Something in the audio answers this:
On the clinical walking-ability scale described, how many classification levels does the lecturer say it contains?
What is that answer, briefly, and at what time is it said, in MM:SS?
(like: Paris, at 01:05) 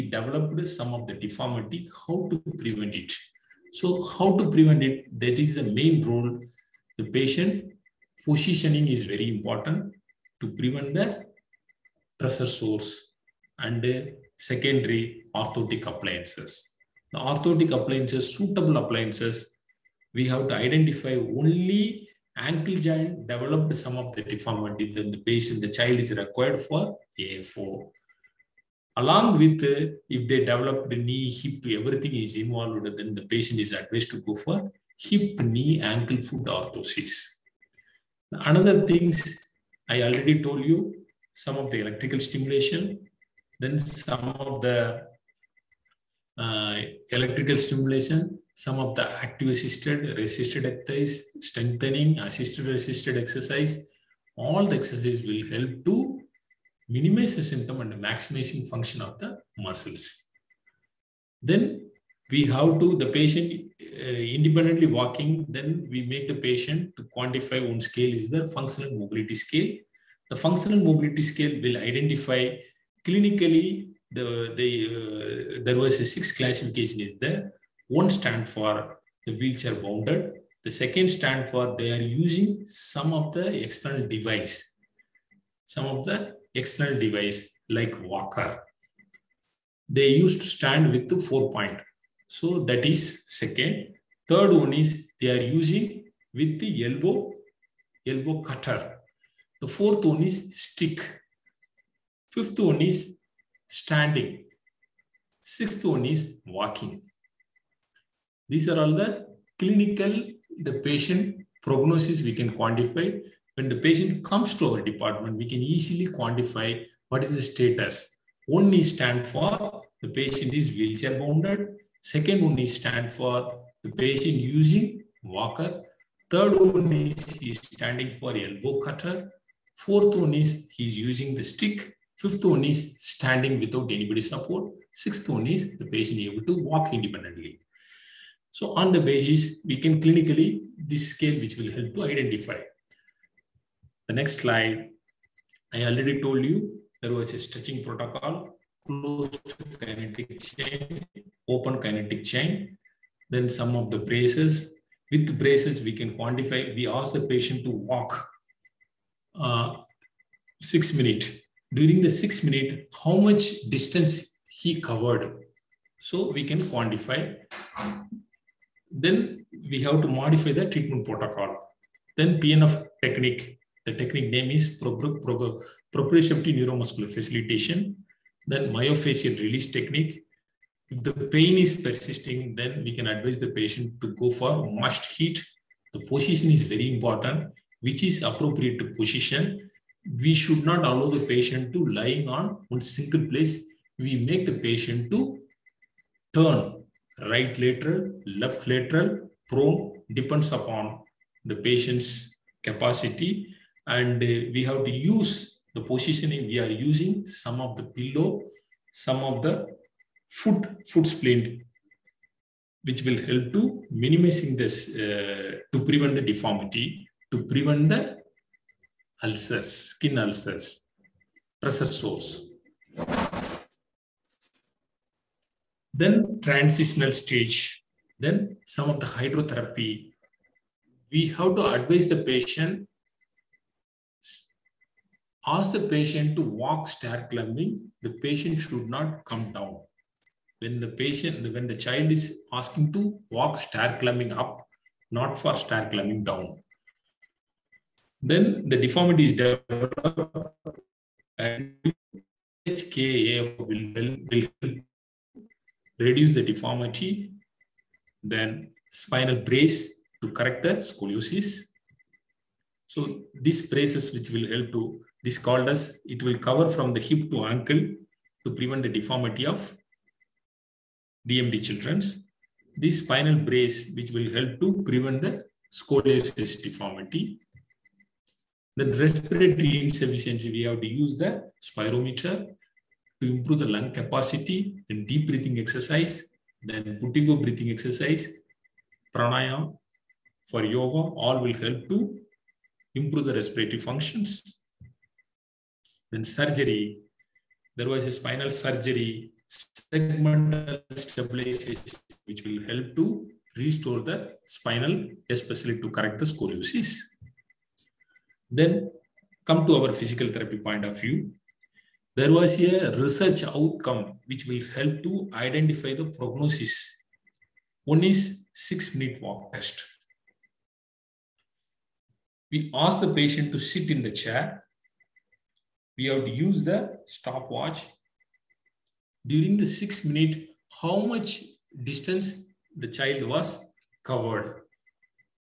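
6, at 01:16.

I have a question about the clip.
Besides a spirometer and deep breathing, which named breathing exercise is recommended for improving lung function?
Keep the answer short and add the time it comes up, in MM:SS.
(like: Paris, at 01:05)
Buteyko breathing exercise, at 04:47.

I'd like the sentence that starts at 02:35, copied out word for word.
With braces, we can quantify, we ask the patient to walk uh, six minute.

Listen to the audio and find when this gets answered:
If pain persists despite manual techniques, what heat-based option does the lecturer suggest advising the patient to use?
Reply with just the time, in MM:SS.
03:04.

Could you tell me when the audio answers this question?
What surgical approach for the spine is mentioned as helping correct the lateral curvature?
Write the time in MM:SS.
04:59.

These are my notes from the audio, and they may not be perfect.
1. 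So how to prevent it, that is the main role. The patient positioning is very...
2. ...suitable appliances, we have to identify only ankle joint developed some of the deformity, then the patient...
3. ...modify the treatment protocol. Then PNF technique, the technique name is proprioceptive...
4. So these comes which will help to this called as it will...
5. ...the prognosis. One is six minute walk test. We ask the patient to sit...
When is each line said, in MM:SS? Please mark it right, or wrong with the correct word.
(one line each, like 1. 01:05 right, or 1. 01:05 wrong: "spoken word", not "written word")
1. 00:03 right
2. 00:18 right
3. 02:50 right
4. 04:22 wrong: "braces", not "comes"
5. 05:16 right.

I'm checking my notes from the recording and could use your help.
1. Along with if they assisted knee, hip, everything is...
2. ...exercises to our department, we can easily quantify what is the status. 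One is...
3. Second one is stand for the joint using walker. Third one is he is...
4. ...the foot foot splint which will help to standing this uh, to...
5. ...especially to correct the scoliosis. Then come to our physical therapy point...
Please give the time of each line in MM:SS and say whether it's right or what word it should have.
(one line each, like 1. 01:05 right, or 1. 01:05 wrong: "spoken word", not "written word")
1. 00:28 wrong: "developed", not "assisted"
2. 01:54 wrong: "comes", not "exercises"
3. 02:02 wrong: "patient", not "joint"
4. 03:29 wrong: "minimizing", not "standing"
5. 05:05 right.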